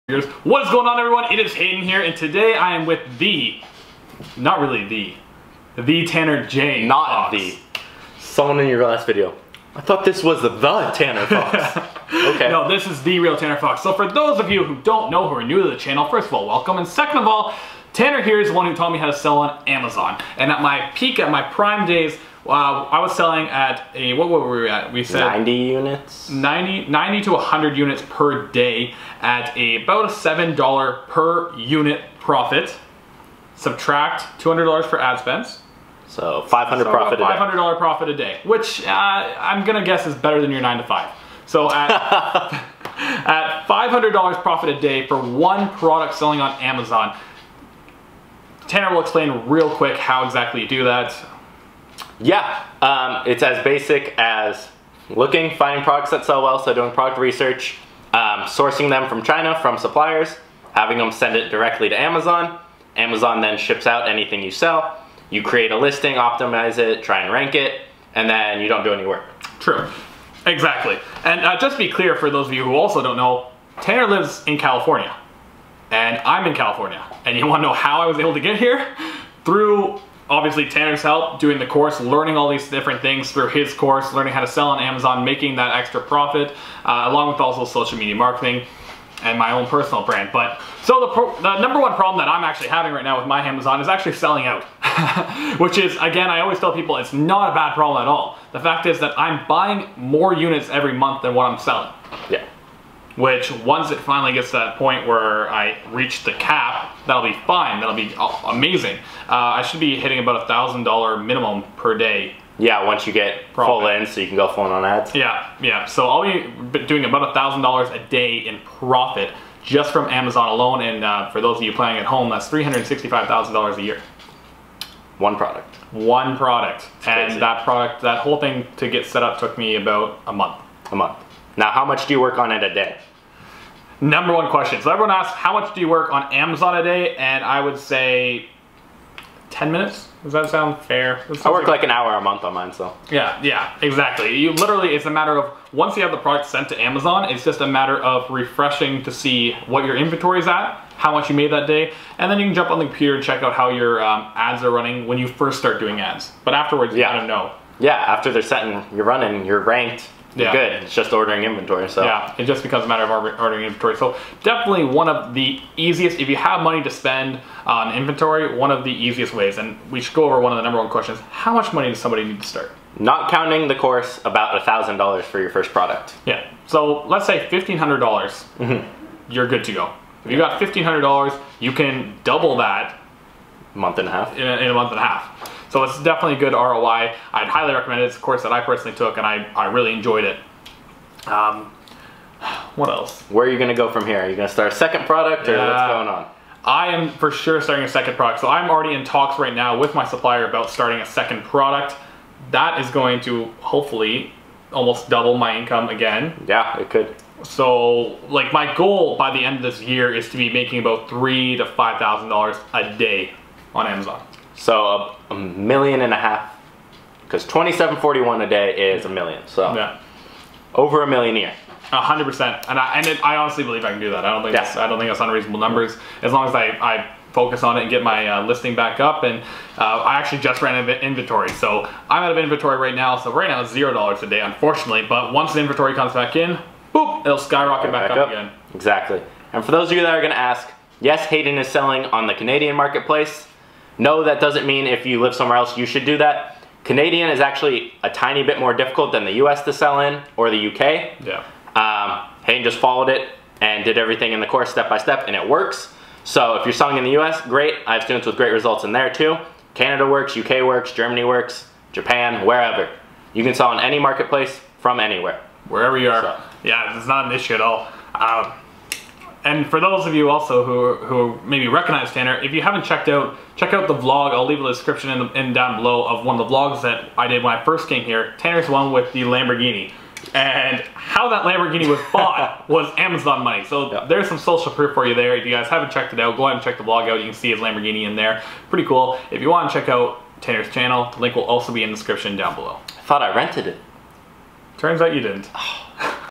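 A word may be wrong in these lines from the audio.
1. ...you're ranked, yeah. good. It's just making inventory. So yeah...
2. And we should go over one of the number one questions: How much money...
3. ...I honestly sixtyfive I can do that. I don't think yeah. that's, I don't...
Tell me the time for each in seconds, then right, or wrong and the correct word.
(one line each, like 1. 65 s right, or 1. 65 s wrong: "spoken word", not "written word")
1. 159 s wrong: "ordering", not "making"
2. 169 s right
3. 223 s wrong: "believe", not "sixtyfive".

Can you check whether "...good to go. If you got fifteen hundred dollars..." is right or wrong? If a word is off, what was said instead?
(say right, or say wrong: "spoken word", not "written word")
right.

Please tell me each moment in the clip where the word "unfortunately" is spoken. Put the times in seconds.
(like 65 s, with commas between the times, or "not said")
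234 s.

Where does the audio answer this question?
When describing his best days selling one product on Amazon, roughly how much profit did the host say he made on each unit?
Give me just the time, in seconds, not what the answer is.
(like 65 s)
30 s.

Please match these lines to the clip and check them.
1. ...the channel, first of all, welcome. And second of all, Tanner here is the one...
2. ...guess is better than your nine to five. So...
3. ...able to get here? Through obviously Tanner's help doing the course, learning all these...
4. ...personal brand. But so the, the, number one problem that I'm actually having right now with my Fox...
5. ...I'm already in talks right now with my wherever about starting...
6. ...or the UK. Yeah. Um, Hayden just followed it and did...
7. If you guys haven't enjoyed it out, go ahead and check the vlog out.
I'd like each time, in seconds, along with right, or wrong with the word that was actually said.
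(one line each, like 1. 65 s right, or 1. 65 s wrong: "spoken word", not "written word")
1. 15 s right
2. 39 s right
3. 78 s right
4. 89 s wrong: "Amazon", not "Fox"
5. 198 s wrong: "supplier", not "wherever"
6. 250 s right
7. 285 s wrong: "checked", not "enjoyed".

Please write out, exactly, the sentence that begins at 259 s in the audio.
Canada works, UK works, Germany works, Japan, wherever.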